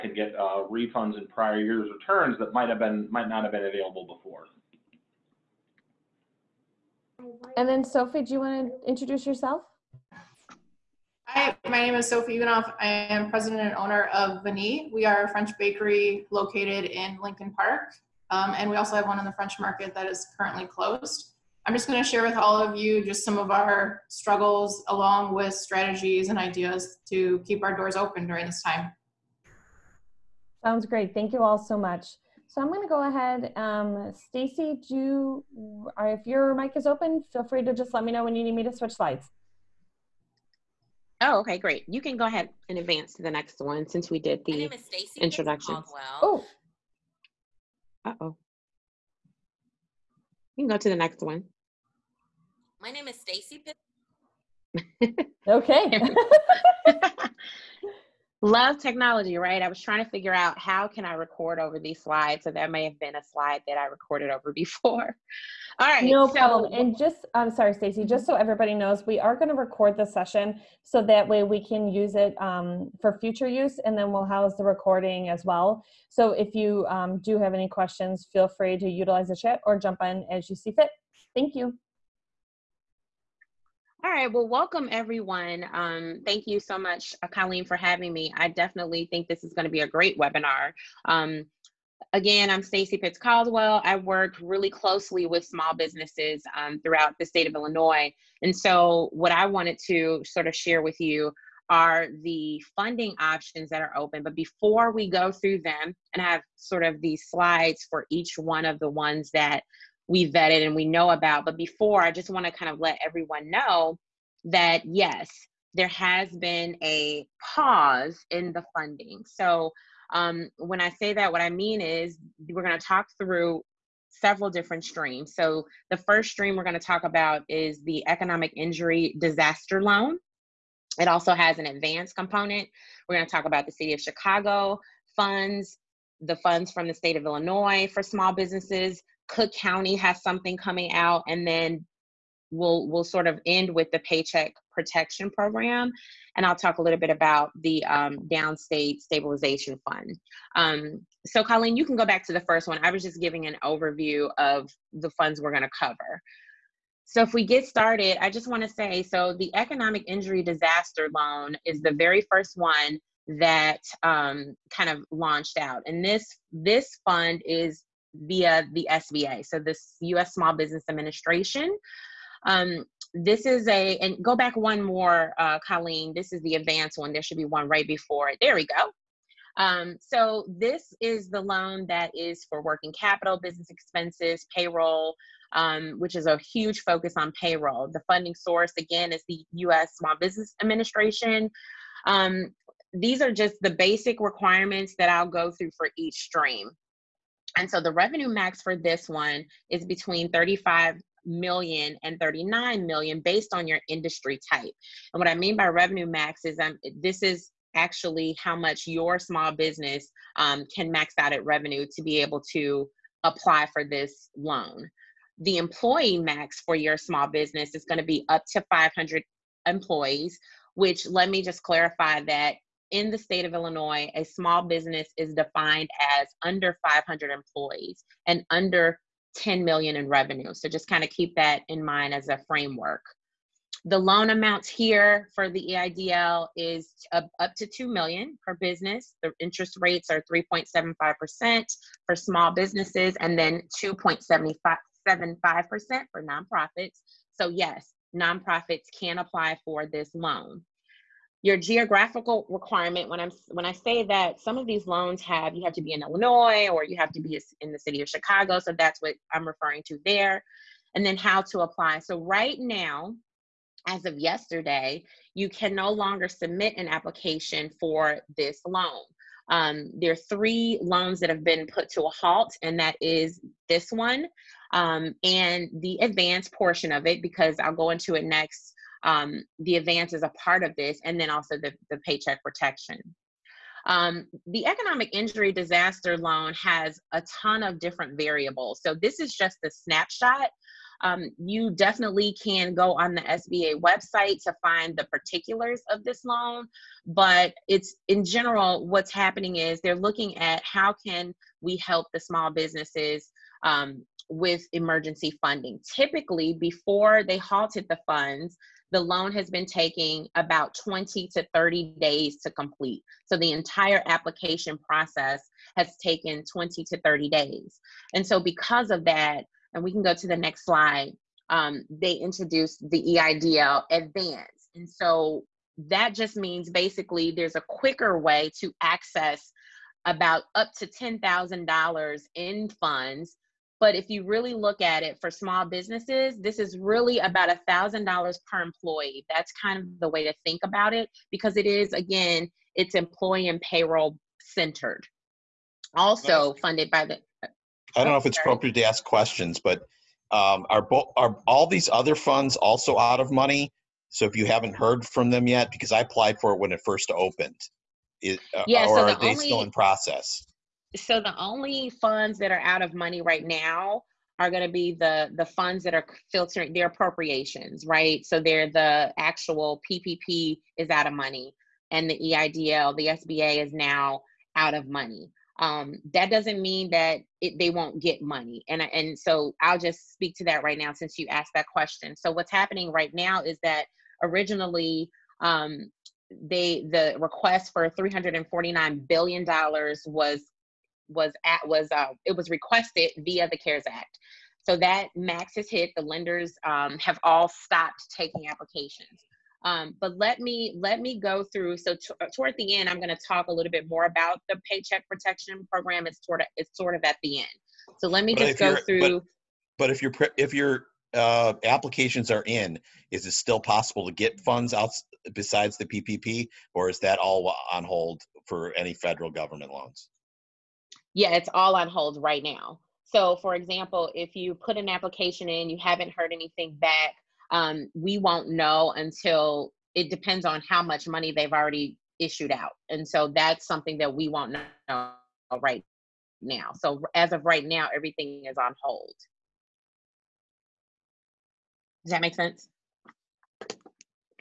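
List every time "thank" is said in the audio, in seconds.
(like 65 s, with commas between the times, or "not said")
31 s, 81 s, 86 s.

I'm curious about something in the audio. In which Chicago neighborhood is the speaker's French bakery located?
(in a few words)
Lincoln Park.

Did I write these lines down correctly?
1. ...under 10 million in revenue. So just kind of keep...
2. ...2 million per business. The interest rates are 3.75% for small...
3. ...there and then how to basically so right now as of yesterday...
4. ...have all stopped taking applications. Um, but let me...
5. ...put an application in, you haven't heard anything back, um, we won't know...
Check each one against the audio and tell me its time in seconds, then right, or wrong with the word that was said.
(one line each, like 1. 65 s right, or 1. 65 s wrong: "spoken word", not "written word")
1. 228 s right
2. 237 s right
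3. 260 s wrong: "apply", not "basically"
4. 396 s right
5. 424 s right.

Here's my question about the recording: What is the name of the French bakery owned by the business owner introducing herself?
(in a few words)
Vanille.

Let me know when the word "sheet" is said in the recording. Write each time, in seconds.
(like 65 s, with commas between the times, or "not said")
not said.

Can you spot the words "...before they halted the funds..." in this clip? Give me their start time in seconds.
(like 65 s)
306 s.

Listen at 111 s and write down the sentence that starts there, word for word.
But before, I just want to kind of let everyone know that yes, there has been a pause in the funding.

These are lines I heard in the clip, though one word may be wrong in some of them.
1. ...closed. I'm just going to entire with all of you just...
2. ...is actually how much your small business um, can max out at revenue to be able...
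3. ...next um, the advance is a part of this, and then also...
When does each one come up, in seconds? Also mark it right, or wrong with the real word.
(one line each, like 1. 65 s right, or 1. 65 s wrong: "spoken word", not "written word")
1. 20 s wrong: "share", not "entire"
2. 207 s right
3. 278 s right.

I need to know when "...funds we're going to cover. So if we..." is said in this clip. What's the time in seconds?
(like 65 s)
155 s.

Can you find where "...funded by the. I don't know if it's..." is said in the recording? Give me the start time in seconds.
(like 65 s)
346 s.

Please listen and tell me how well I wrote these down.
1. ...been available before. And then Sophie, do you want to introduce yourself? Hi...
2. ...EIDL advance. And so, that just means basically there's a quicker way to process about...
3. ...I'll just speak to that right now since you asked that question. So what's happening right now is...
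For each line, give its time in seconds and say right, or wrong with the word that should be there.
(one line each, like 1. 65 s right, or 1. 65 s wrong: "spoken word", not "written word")
1. 3 s right
2. 323 s wrong: "access", not "process"
3. 379 s right.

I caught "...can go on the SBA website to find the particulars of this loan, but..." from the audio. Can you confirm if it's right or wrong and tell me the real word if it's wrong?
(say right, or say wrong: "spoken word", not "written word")
right.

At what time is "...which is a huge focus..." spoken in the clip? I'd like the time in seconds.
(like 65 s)
185 s.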